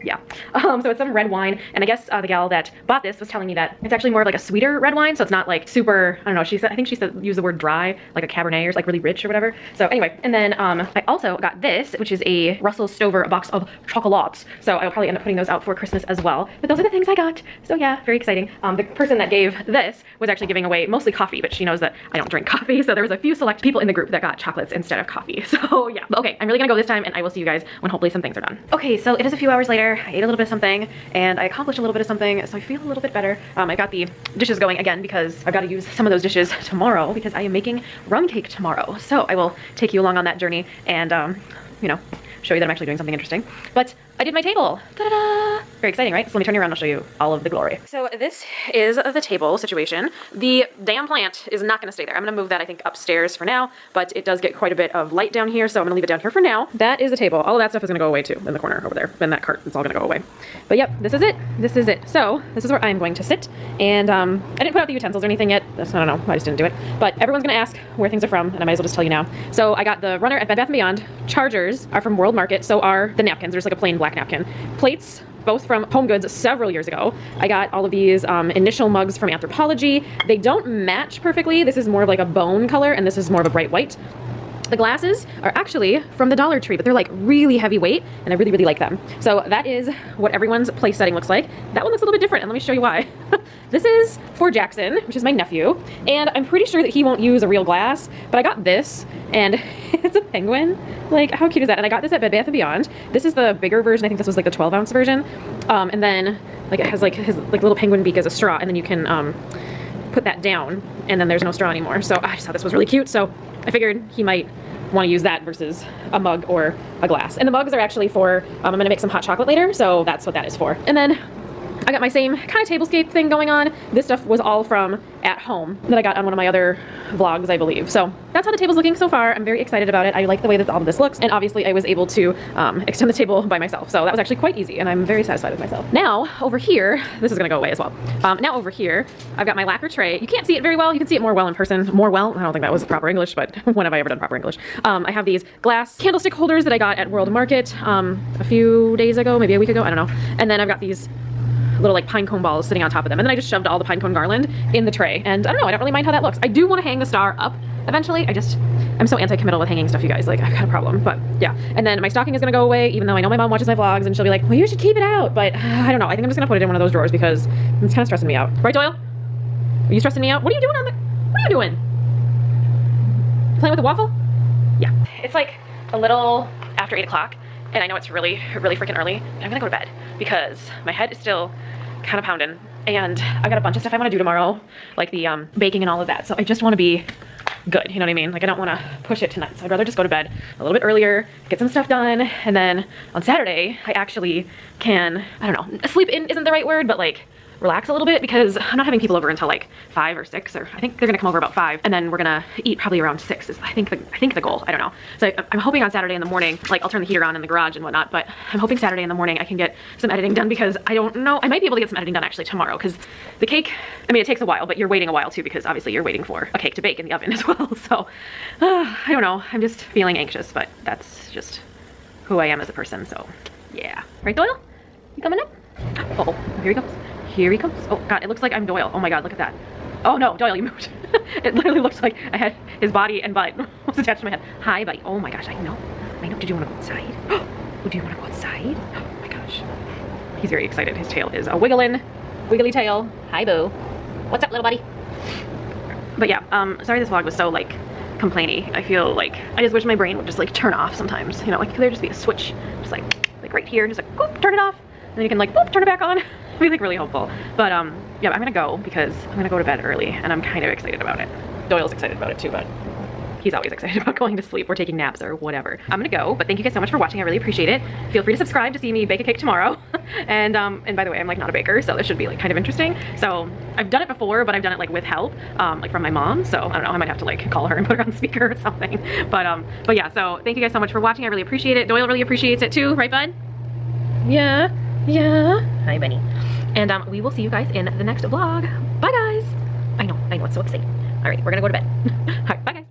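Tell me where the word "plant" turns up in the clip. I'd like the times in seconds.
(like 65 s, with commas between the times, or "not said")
51 s.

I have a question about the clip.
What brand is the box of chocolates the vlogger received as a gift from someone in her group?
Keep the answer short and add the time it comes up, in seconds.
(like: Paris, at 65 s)
Russell Stover, at 12 s.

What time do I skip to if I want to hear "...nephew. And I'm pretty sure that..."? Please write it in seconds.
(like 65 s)
95 s.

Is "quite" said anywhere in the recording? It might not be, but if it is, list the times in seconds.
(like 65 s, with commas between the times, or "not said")
54 s, 134 s.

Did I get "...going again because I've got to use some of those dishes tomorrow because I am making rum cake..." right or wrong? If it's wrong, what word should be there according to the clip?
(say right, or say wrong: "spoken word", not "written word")
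right.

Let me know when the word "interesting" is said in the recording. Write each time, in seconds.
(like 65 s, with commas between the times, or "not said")
43 s, 272 s.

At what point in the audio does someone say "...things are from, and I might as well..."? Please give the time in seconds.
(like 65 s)
68 s.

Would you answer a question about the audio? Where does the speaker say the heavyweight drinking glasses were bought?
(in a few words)
Dollar Tree.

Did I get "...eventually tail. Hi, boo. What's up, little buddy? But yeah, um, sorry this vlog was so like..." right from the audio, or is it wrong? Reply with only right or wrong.
wrong.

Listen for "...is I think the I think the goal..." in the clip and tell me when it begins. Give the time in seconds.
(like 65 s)
203 s.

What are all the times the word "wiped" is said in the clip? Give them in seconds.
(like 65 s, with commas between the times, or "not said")
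not said.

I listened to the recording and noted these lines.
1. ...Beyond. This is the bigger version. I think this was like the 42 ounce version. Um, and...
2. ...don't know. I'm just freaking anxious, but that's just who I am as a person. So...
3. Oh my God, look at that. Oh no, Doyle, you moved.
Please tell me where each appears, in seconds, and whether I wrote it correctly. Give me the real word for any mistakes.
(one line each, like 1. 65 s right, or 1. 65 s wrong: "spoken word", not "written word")
1. 102 s wrong: "12", not "42"
2. 219 s wrong: "feeling", not "freaking"
3. 228 s right.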